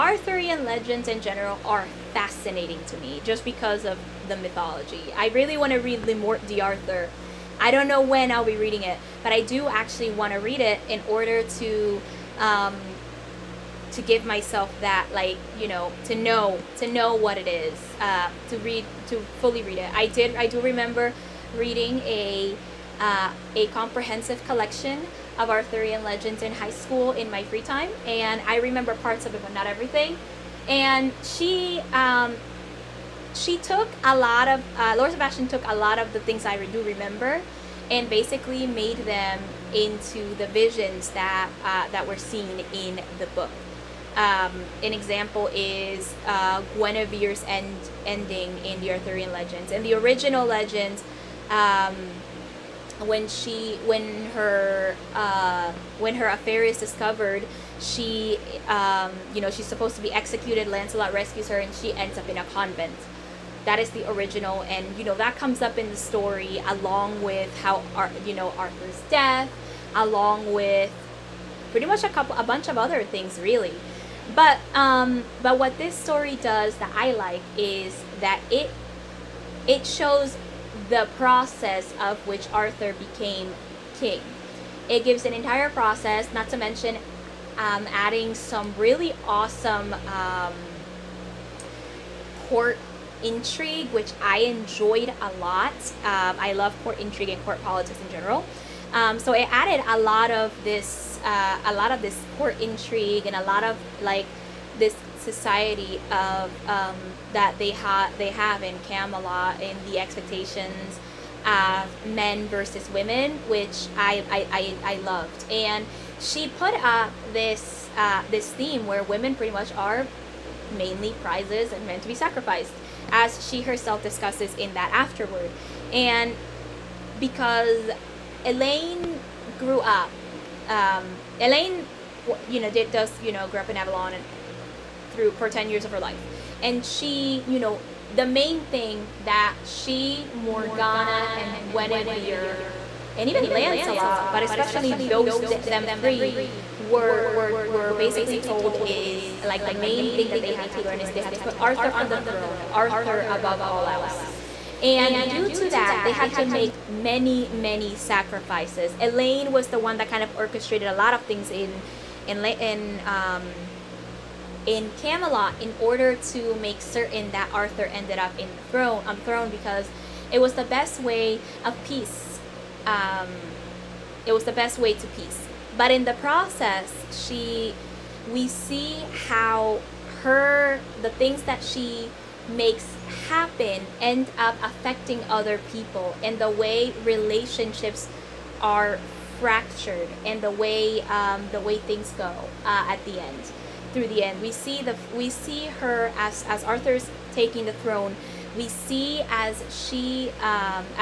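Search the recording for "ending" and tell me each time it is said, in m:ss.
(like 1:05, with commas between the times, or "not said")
0:48.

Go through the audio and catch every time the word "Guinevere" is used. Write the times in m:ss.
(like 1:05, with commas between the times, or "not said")
0:46, 2:21.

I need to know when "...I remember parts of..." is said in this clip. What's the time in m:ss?
0:28.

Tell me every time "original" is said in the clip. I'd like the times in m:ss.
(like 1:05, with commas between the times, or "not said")
0:49, 1:04.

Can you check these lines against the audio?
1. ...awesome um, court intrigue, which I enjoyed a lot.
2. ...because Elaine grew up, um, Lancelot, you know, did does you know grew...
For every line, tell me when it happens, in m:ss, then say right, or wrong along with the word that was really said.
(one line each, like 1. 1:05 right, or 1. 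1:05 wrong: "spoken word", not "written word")
1. 1:29 right
2. 2:07 wrong: "Elaine", not "Lancelot".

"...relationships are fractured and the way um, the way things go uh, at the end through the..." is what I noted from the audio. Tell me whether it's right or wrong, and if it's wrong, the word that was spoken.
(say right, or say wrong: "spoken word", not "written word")
right.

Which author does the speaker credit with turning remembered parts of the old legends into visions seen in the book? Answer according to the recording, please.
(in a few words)
Laura Sebastian.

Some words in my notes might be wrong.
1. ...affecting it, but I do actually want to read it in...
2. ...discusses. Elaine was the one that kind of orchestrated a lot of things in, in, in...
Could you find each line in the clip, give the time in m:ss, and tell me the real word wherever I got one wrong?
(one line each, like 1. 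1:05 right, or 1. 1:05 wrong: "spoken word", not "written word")
1. 0:08 wrong: "reading", not "affecting"
2. 2:37 wrong: "sacrifices", not "discusses".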